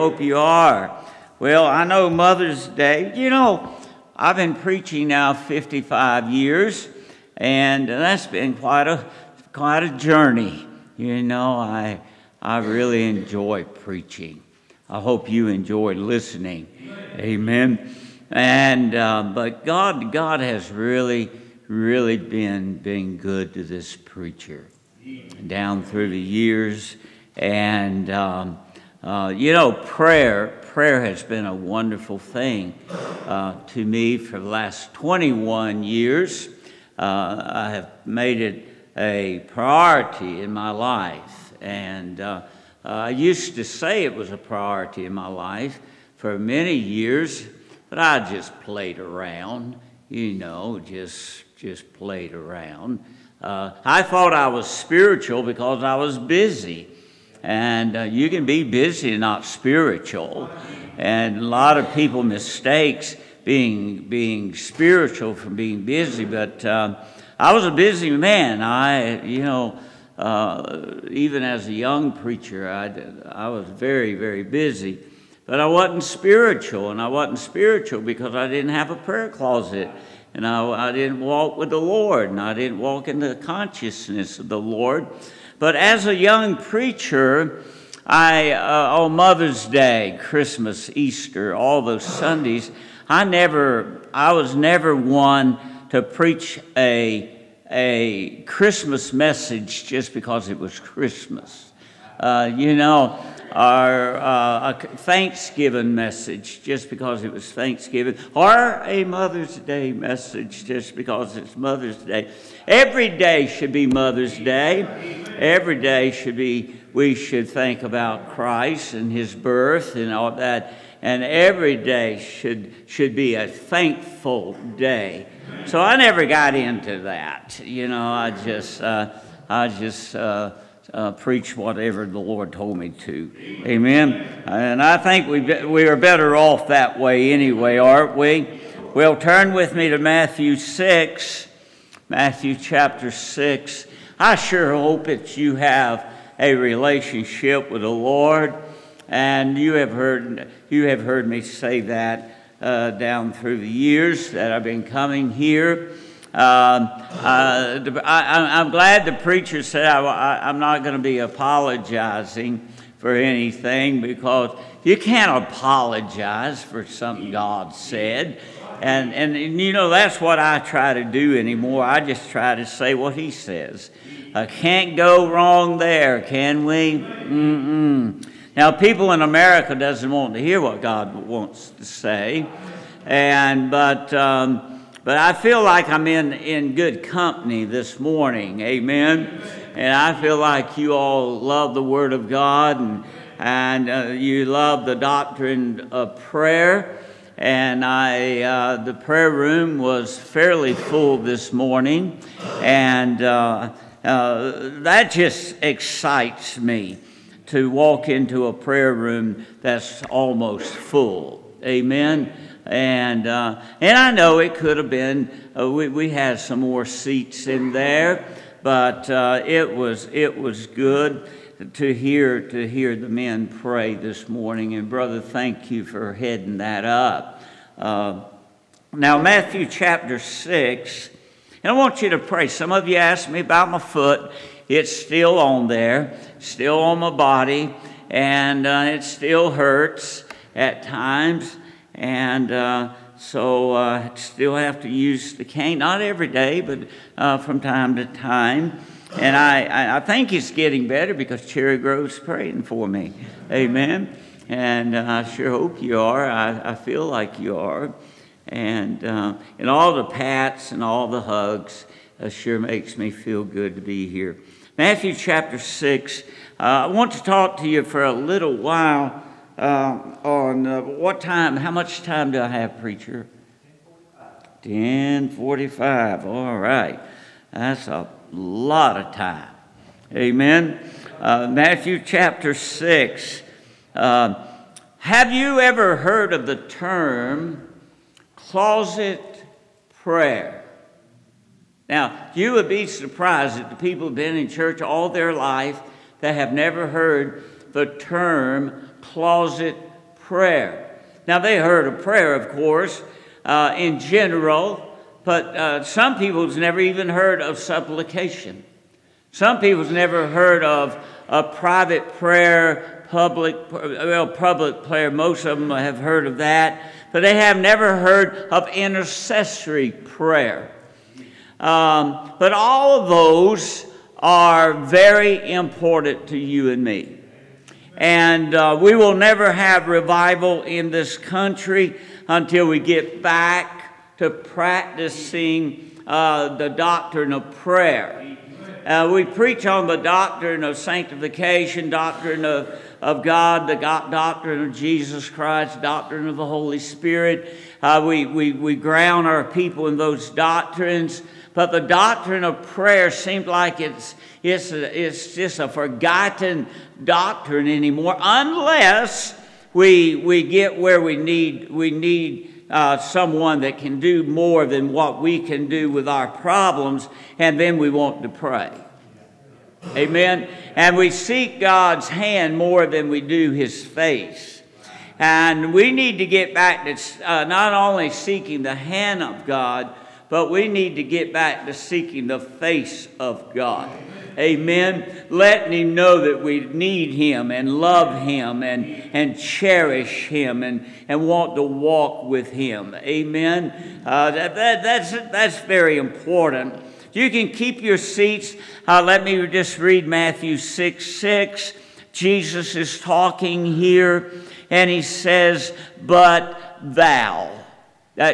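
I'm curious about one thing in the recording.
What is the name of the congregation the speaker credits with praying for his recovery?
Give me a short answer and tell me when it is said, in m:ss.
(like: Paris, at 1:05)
Cherry Grove, at 4:11.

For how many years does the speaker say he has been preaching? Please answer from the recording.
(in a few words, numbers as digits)
55.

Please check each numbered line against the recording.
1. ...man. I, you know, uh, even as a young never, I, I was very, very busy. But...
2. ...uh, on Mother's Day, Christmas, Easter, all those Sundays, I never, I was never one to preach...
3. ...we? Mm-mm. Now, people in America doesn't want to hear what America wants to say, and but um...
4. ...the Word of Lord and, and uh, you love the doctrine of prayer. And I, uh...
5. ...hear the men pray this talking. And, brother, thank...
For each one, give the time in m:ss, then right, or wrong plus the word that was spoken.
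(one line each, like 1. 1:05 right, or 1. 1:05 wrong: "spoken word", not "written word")
1. 1:08 wrong: "preacher", not "never"
2. 1:28 right
3. 2:56 wrong: "God", not "America"
4. 3:11 wrong: "God", not "Lord"
5. 3:42 wrong: "morning", not "talking".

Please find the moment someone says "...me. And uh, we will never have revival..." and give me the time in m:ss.
5:26.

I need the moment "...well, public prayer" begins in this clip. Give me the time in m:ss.
5:13.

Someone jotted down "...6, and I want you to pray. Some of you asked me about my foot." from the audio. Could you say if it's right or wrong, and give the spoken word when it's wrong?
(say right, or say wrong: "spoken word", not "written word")
right.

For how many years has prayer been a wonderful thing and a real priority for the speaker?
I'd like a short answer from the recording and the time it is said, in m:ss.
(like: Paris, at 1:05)
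21, at 0:34.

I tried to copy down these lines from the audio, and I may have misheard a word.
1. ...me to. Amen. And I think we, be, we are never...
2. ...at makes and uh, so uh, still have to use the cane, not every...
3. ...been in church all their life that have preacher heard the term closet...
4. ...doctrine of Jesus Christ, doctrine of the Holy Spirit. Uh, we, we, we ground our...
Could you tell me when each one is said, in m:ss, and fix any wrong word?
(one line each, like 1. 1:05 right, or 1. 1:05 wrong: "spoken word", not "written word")
1. 2:12 wrong: "better", not "never"
2. 4:00 wrong: "times", not "makes"
3. 4:54 wrong: "never", not "preacher"
4. 5:44 right.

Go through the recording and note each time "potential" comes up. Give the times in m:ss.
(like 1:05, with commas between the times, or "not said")
not said.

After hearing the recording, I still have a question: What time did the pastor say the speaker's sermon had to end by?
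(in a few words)
10:45.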